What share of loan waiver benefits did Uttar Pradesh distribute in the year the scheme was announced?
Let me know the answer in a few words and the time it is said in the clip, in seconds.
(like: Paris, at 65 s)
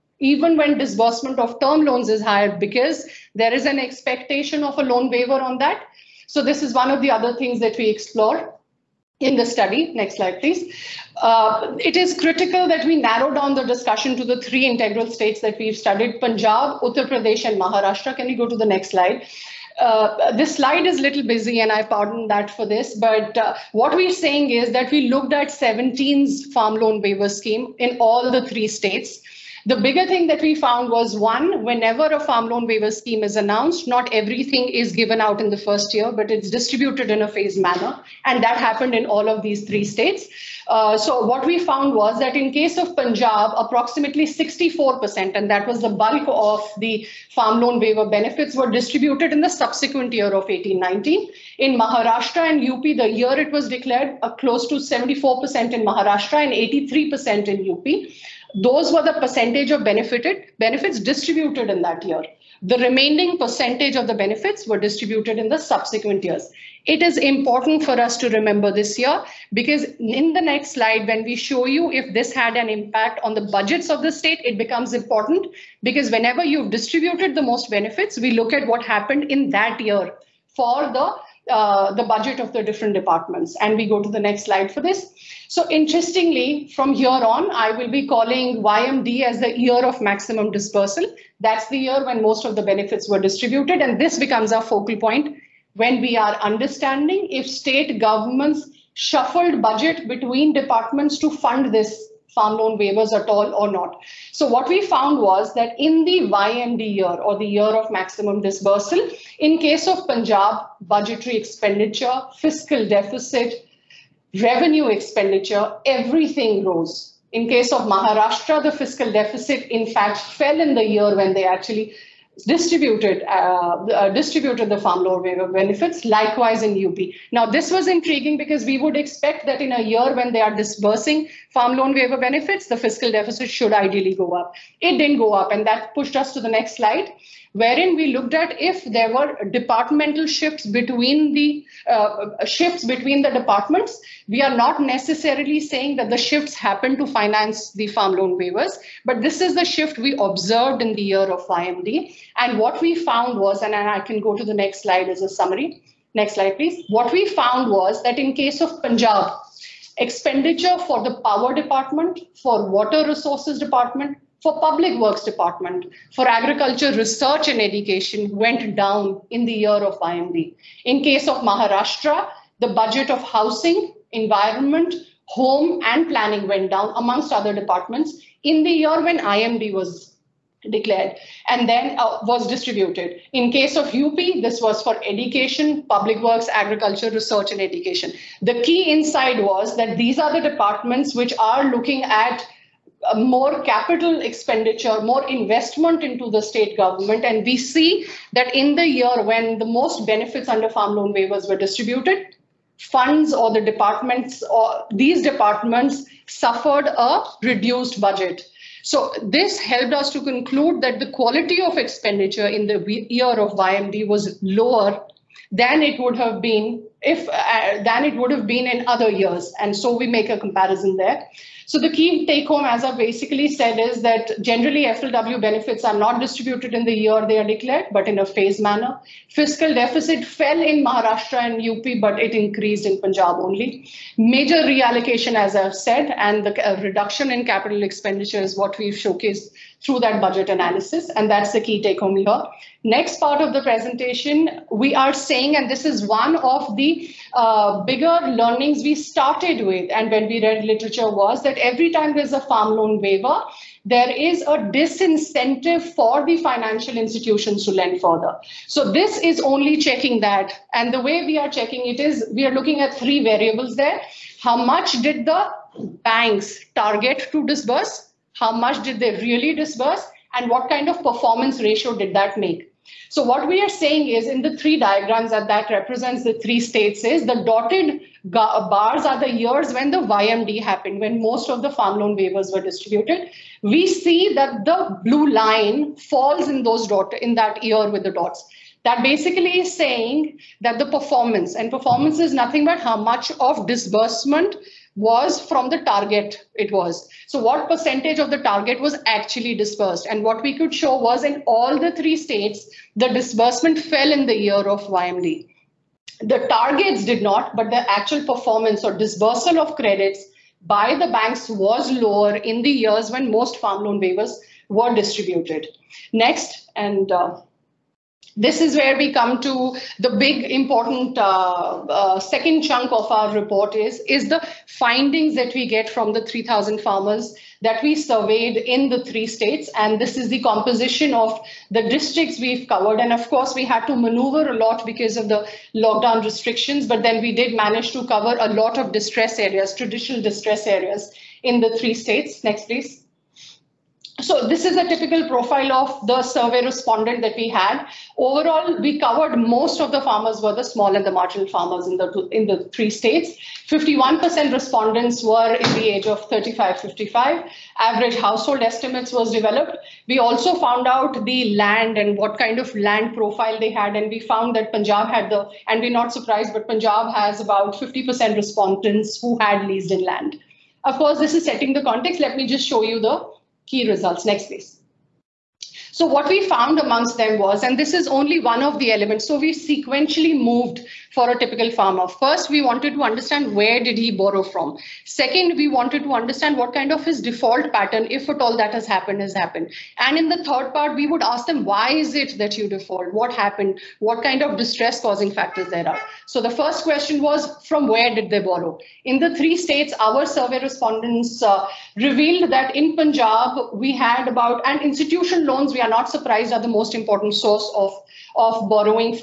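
83%, at 56 s.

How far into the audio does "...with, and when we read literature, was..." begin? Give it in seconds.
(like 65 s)
249 s.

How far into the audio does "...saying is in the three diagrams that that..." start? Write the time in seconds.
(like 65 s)
273 s.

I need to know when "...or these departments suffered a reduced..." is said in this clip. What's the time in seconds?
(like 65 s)
204 s.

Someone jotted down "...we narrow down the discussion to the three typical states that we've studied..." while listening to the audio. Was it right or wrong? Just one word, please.
wrong.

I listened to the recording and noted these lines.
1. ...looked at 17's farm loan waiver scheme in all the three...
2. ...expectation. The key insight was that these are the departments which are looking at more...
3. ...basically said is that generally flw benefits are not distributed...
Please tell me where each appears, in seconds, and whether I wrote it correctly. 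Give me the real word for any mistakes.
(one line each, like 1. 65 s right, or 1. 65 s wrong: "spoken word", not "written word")
1. 25 s right
2. 187 s wrong: "education", not "expectation"
3. 222 s right.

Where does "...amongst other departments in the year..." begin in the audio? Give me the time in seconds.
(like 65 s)
176 s.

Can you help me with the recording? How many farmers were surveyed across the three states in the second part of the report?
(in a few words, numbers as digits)
3,000.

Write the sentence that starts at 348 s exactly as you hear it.
Overall, we covered most of the farmers were the small and the marginal farmers in the in the three states.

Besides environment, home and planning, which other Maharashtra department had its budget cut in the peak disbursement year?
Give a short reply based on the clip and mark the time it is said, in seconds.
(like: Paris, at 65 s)
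housing, at 173 s.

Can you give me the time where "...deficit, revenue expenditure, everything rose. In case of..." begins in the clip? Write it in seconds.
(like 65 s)
112 s.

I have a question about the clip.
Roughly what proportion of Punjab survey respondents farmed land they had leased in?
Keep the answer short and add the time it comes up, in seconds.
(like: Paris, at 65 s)
50%, at 367 s.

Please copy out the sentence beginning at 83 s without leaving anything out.
And we go to the next slide for this.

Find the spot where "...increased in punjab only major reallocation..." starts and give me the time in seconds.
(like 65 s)
232 s.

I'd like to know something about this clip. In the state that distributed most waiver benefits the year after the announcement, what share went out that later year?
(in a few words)
64%.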